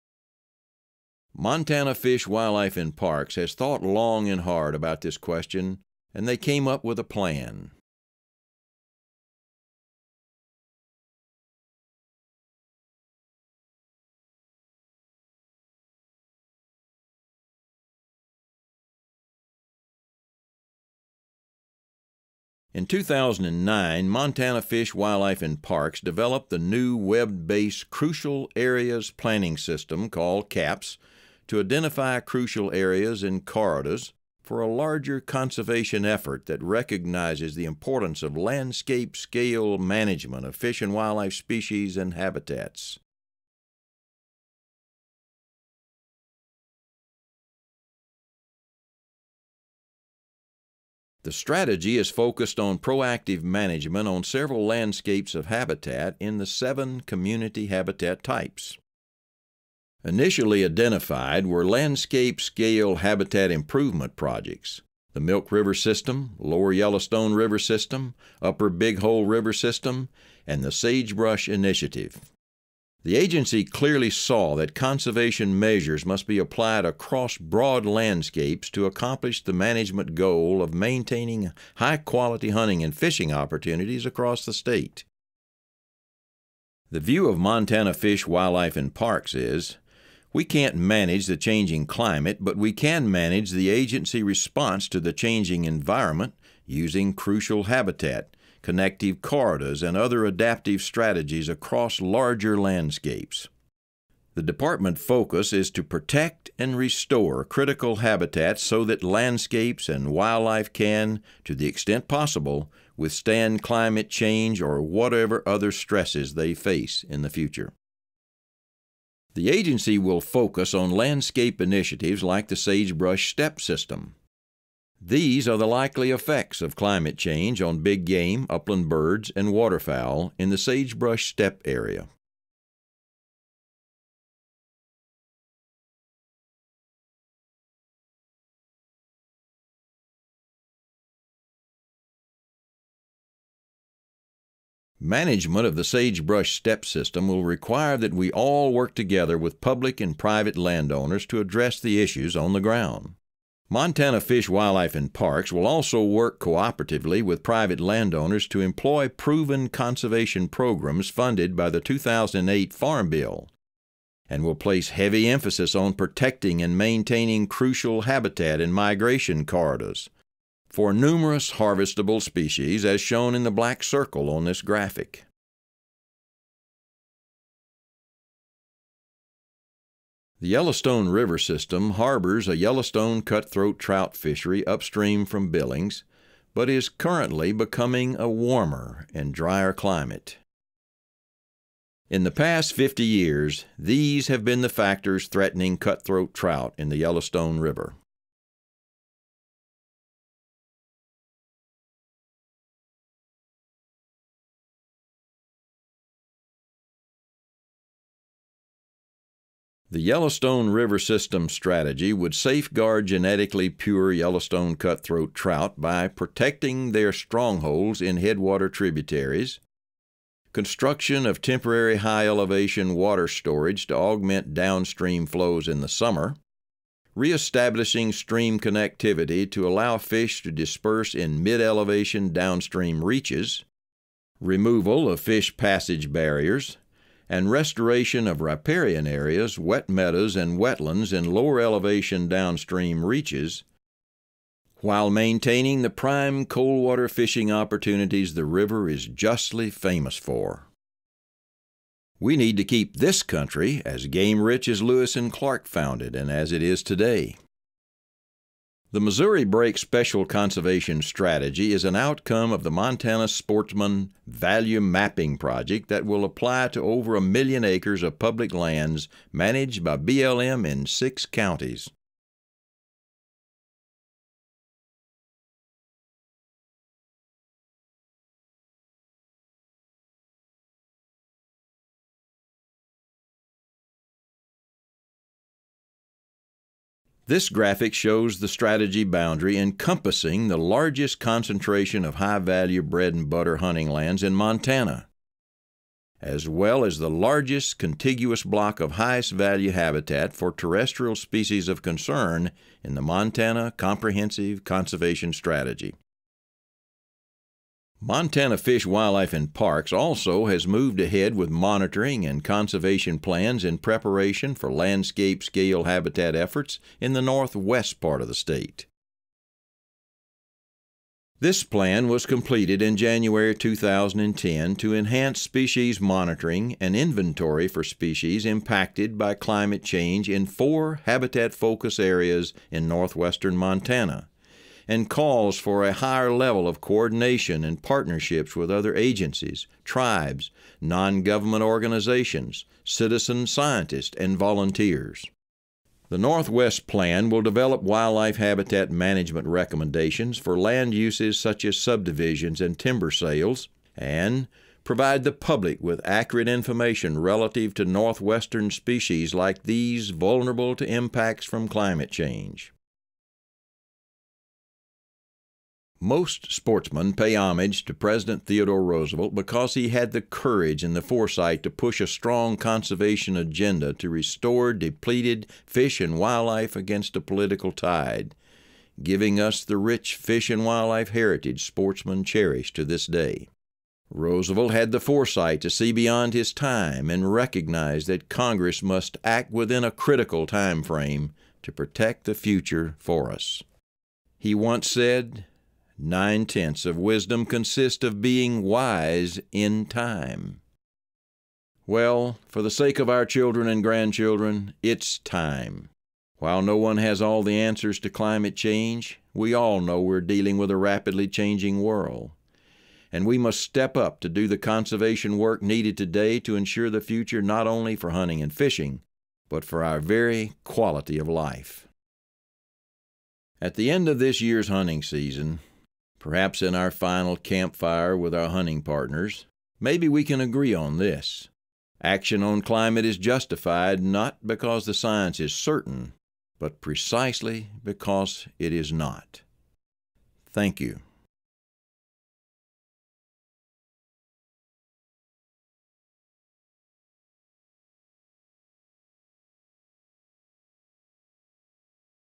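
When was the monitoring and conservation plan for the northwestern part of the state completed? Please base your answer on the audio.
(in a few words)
January 2010.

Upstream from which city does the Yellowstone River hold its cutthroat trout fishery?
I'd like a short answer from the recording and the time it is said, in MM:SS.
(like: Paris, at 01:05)
Billings, at 03:05.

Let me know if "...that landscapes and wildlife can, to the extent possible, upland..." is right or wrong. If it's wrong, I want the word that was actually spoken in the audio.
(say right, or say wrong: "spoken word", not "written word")
wrong: "withstand", not "upland".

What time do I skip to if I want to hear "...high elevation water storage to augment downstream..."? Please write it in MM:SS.
03:41.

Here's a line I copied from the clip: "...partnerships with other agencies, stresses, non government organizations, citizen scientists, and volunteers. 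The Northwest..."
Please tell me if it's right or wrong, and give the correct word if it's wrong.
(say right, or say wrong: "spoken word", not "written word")
wrong: "tribes", not "stresses".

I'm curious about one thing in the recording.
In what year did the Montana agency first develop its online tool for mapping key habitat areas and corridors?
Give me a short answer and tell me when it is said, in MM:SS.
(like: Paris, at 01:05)
2009, at 00:22.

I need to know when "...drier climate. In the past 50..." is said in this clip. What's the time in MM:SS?
03:09.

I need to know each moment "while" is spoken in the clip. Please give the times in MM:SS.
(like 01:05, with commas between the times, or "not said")
04:04, 06:46.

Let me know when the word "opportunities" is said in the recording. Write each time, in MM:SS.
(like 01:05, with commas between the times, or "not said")
01:23, 04:07.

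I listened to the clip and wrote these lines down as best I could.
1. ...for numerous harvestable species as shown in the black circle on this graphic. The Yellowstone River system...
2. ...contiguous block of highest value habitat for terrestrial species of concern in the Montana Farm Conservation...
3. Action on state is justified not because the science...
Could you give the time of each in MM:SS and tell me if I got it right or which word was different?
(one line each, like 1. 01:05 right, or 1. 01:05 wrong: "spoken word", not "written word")
1. 02:50 right
2. 04:57 wrong: "Comprehensive", not "Farm"
3. 07:12 wrong: "climate", not "state".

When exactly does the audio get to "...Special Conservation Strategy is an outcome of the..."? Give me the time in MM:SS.
04:19.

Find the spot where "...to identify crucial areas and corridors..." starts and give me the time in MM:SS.
00:31.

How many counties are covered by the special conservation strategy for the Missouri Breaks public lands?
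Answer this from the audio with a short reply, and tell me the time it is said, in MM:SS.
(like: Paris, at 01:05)
6, at 04:30.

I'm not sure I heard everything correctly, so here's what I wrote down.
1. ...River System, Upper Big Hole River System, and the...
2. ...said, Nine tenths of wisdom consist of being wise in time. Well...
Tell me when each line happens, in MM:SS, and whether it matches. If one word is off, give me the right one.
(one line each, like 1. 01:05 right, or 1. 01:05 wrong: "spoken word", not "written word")
1. 01:07 right
2. 06:34 right.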